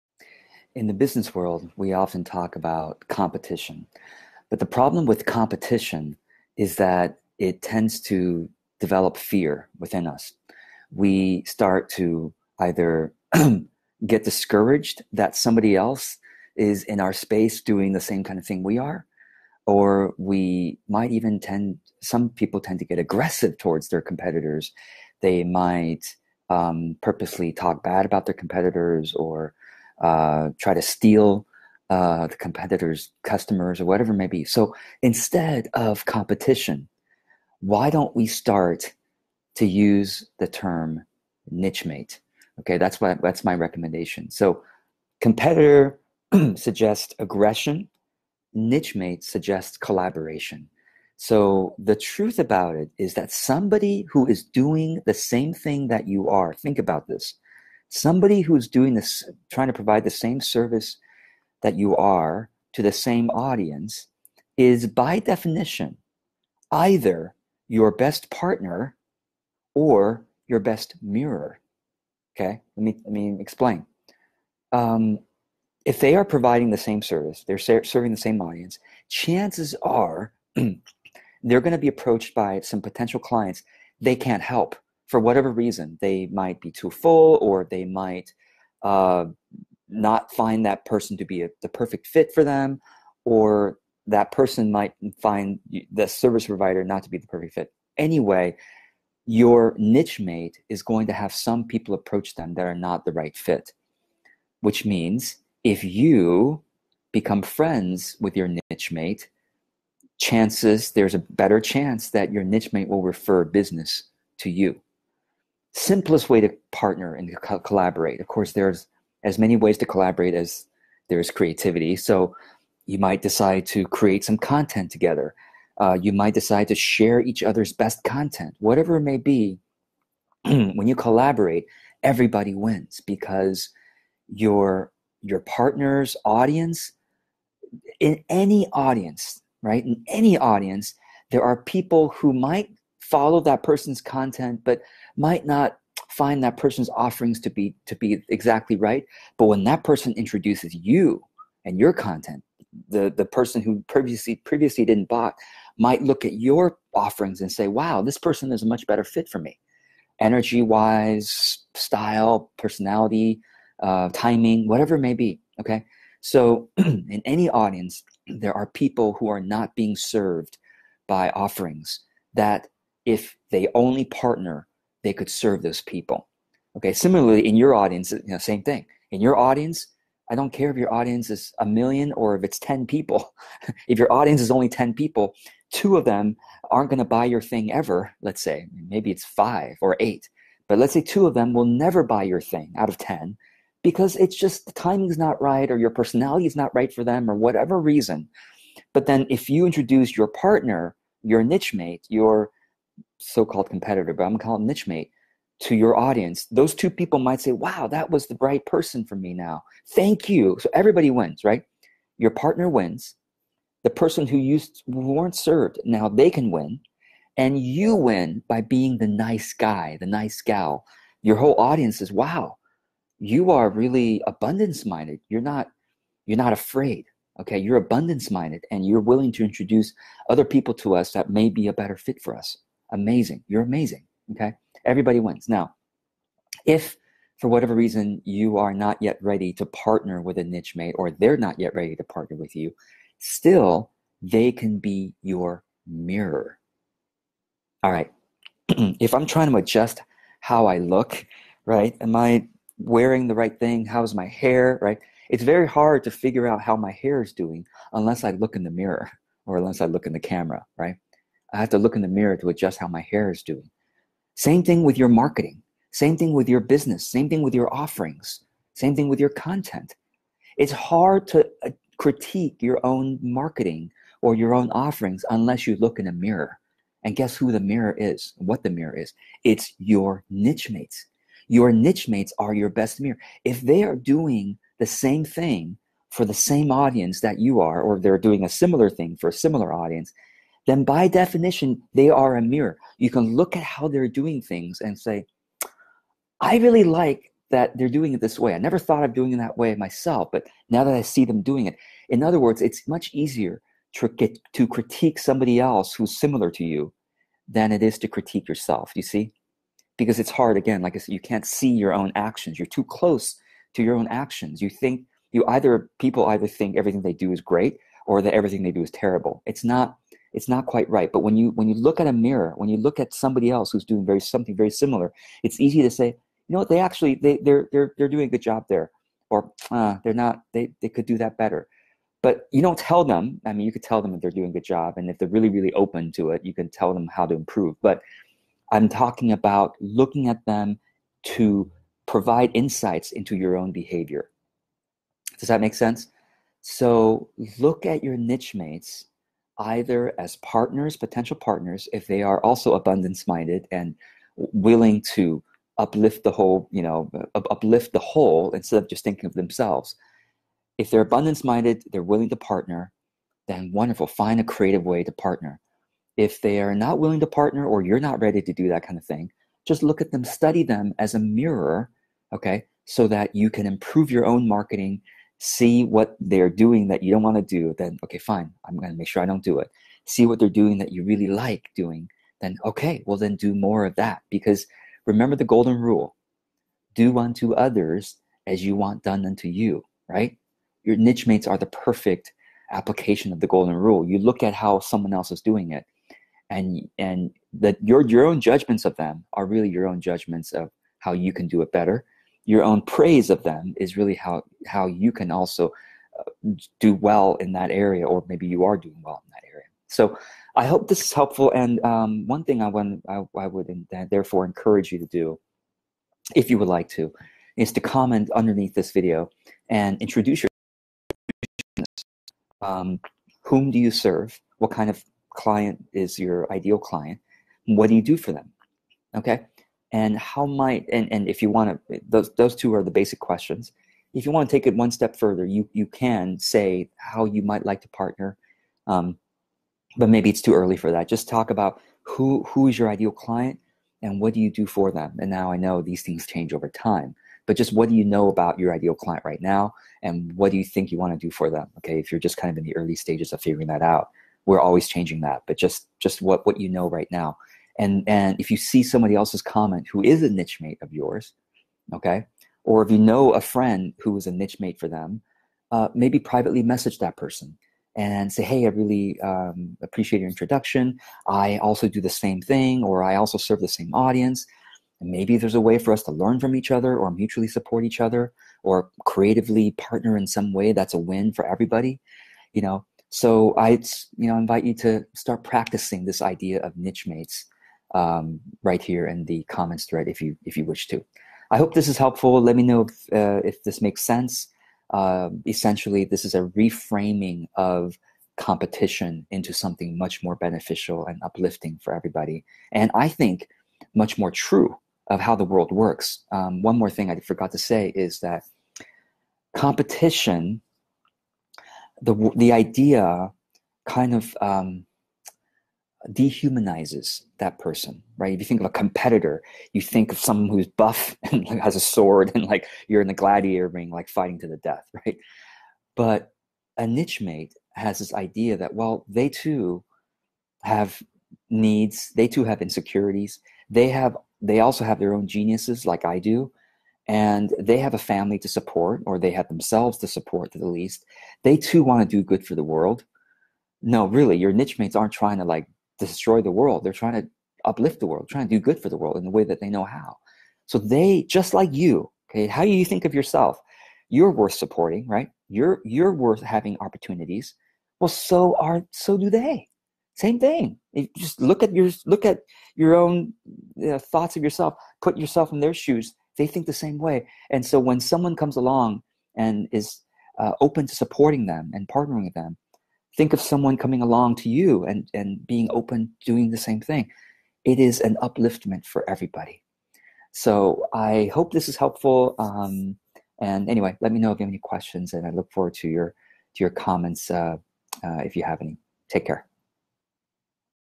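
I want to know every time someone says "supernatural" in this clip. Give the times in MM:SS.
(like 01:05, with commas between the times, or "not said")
not said.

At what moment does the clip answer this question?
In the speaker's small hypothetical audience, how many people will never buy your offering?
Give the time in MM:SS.
03:11.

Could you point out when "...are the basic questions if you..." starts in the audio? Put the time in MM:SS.
07:12.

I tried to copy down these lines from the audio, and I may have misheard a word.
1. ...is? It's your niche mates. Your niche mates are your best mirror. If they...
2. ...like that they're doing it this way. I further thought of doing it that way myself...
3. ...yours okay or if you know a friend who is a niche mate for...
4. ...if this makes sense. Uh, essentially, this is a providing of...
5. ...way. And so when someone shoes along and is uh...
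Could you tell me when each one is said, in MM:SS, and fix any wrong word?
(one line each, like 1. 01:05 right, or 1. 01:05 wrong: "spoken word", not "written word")
1. 04:38 right
2. 04:56 wrong: "never", not "further"
3. 07:40 right
4. 08:13 wrong: "reframing", not "providing"
5. 09:26 wrong: "comes", not "shoes".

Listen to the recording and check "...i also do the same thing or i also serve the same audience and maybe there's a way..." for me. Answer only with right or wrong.
right.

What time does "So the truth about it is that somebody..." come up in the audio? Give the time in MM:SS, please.
00:51.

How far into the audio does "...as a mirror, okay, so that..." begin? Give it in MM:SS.
06:10.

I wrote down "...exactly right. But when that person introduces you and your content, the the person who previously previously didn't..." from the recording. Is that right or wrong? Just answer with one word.
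right.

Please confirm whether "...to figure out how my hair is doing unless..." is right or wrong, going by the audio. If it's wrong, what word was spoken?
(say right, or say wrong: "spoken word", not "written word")
right.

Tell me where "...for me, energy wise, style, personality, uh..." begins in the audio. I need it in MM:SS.
02:39.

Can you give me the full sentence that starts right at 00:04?
But the problem with competition is that it tends to develop fear within us.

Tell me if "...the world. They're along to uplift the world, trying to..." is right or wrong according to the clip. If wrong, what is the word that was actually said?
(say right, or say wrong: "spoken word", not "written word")
wrong: "trying", not "along".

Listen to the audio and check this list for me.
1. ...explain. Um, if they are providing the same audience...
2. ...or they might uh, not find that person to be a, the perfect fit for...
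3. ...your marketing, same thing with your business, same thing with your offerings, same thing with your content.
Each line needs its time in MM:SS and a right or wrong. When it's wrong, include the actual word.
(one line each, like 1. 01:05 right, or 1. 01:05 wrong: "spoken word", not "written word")
1. 01:13 wrong: "service", not "audience"
2. 01:27 right
3. 04:24 right.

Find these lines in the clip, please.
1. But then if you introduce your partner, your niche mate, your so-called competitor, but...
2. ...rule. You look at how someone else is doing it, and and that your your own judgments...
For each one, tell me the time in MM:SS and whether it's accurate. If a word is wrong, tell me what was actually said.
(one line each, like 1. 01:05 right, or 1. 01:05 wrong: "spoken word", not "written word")
1. 03:18 right
2. 06:33 right.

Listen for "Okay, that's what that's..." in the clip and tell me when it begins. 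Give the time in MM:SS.
00:42.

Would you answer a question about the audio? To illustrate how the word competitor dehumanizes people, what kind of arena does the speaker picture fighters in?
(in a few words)
gladiator ring.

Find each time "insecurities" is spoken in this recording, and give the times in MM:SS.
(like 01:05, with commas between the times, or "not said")
08:52.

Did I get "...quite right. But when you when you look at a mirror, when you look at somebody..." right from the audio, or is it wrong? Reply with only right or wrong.
right.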